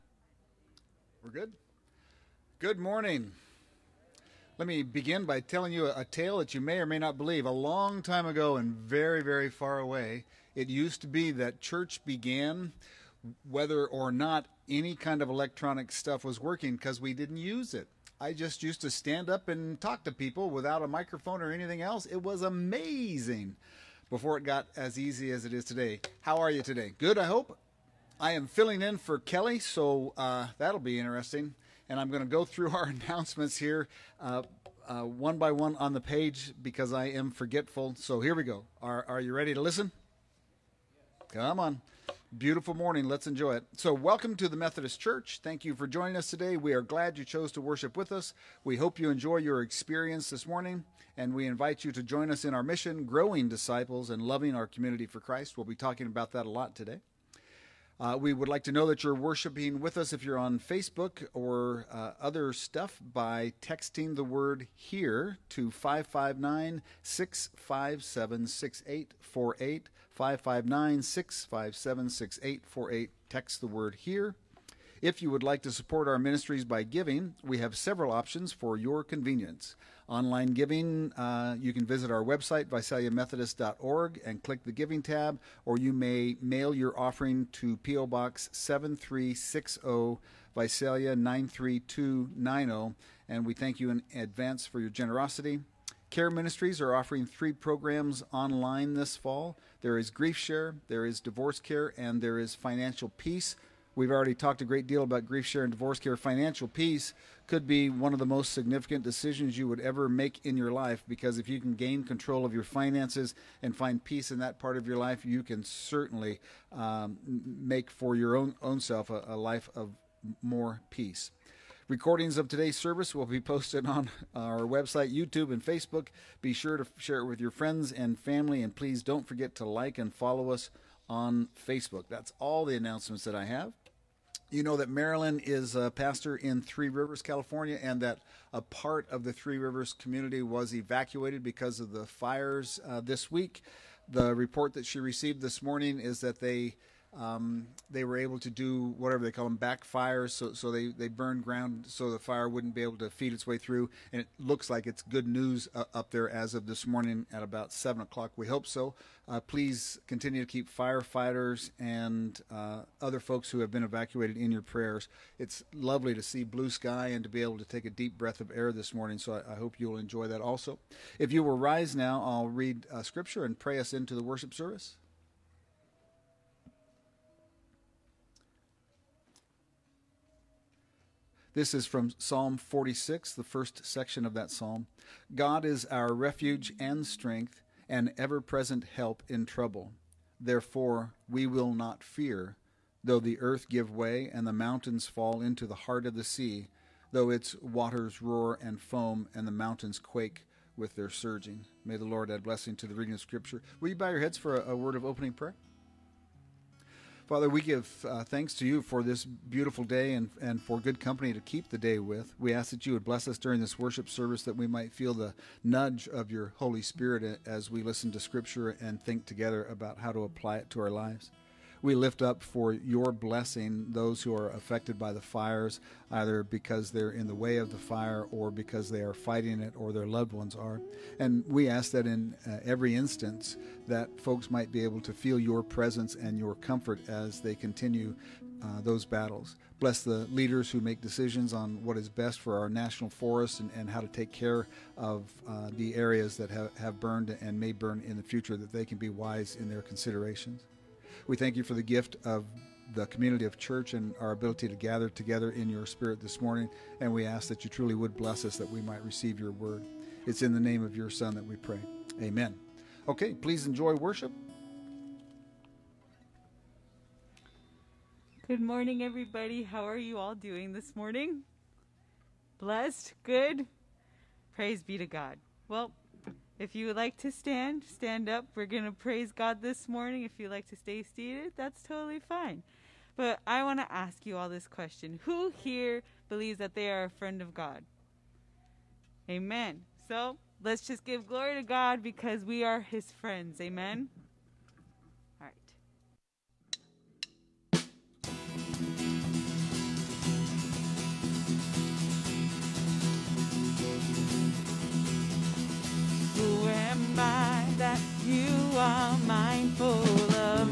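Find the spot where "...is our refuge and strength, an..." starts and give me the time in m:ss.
3:05.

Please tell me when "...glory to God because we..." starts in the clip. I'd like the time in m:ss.
4:51.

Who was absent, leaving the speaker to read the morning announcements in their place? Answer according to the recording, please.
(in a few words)
Kelly.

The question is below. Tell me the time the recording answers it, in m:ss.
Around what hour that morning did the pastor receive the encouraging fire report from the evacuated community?
2:37.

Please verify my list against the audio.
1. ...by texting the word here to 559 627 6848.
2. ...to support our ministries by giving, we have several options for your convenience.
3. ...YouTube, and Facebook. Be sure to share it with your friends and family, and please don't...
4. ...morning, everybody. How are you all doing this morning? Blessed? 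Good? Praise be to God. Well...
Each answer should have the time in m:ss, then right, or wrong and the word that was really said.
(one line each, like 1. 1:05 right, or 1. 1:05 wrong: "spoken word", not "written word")
1. 1:03 wrong: "657", not "627"
2. 1:15 right
3. 2:05 right
4. 4:28 right.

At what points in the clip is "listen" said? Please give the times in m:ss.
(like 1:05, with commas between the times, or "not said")
0:39, 3:37.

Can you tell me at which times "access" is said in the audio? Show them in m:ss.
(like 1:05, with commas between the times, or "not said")
not said.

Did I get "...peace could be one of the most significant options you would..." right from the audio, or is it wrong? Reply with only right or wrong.
wrong.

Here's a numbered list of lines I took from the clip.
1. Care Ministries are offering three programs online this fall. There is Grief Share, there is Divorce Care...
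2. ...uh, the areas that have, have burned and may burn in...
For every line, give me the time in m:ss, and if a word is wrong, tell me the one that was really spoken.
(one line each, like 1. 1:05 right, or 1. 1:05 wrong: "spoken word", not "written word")
1. 1:36 right
2. 4:05 right.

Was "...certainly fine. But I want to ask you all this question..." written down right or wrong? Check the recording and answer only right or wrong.
wrong.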